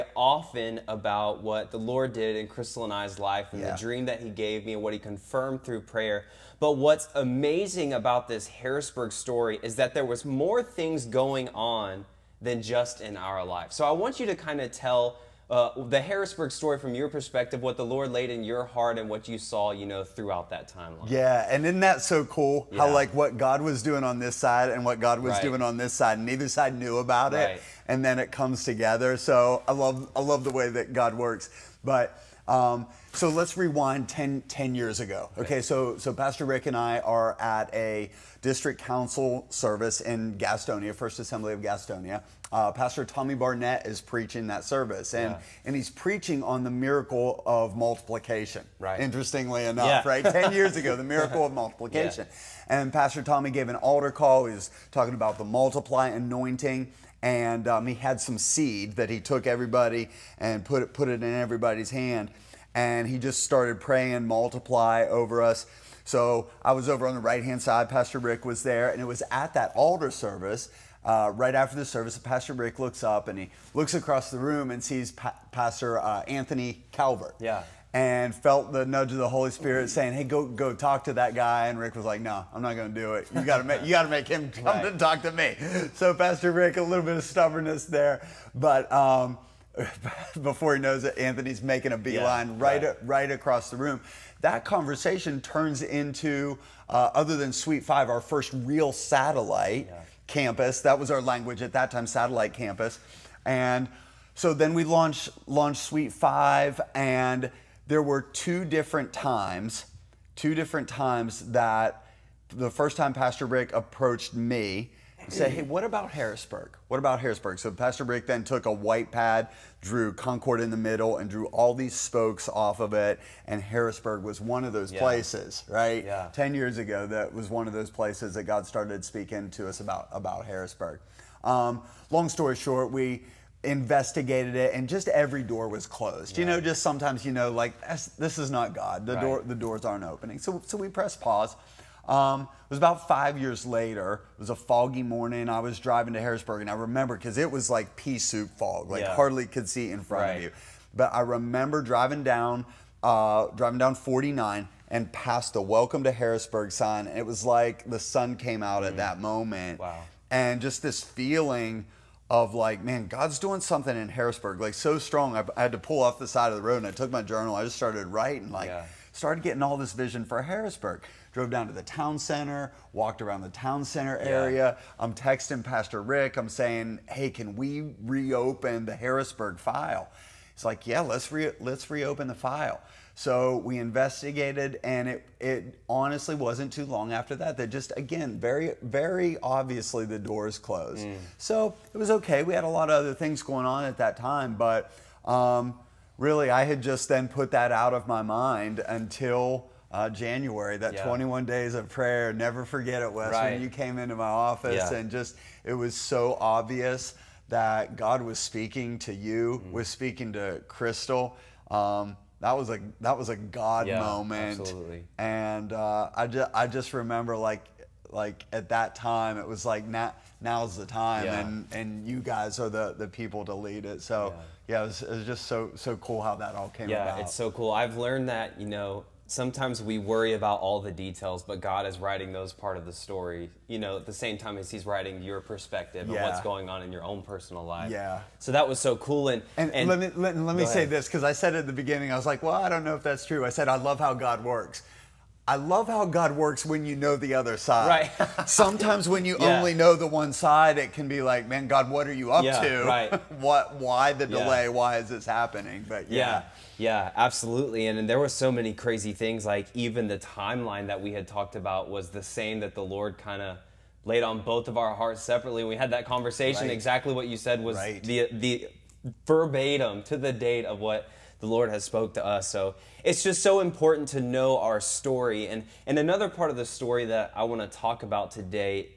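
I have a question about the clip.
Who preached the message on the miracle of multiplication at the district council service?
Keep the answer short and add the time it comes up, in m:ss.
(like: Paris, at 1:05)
Tommy Barnett, at 0:43.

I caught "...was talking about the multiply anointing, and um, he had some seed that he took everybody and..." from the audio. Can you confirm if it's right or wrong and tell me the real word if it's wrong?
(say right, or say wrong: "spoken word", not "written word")
right.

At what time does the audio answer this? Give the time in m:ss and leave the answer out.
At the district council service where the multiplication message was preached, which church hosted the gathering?
0:40.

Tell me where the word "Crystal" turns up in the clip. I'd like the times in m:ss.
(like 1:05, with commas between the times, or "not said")
0:02, 3:30.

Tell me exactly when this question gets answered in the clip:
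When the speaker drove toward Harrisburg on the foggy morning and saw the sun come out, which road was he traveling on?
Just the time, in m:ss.
2:33.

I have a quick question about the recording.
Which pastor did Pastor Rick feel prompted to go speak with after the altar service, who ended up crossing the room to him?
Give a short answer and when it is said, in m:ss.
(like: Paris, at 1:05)
Anthony Calvert, at 1:16.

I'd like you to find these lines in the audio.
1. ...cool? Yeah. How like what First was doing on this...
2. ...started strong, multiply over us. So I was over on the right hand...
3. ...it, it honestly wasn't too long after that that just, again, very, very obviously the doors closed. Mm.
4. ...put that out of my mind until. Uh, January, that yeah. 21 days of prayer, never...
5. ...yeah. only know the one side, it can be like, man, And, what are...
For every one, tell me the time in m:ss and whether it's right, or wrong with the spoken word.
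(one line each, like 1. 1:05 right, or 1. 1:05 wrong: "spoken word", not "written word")
1. 0:22 wrong: "God", not "First"
2. 1:03 wrong: "praying", not "strong"
3. 3:05 right
4. 3:17 right
5. 4:09 wrong: "God", not "And".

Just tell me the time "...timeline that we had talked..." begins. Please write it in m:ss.
4:20.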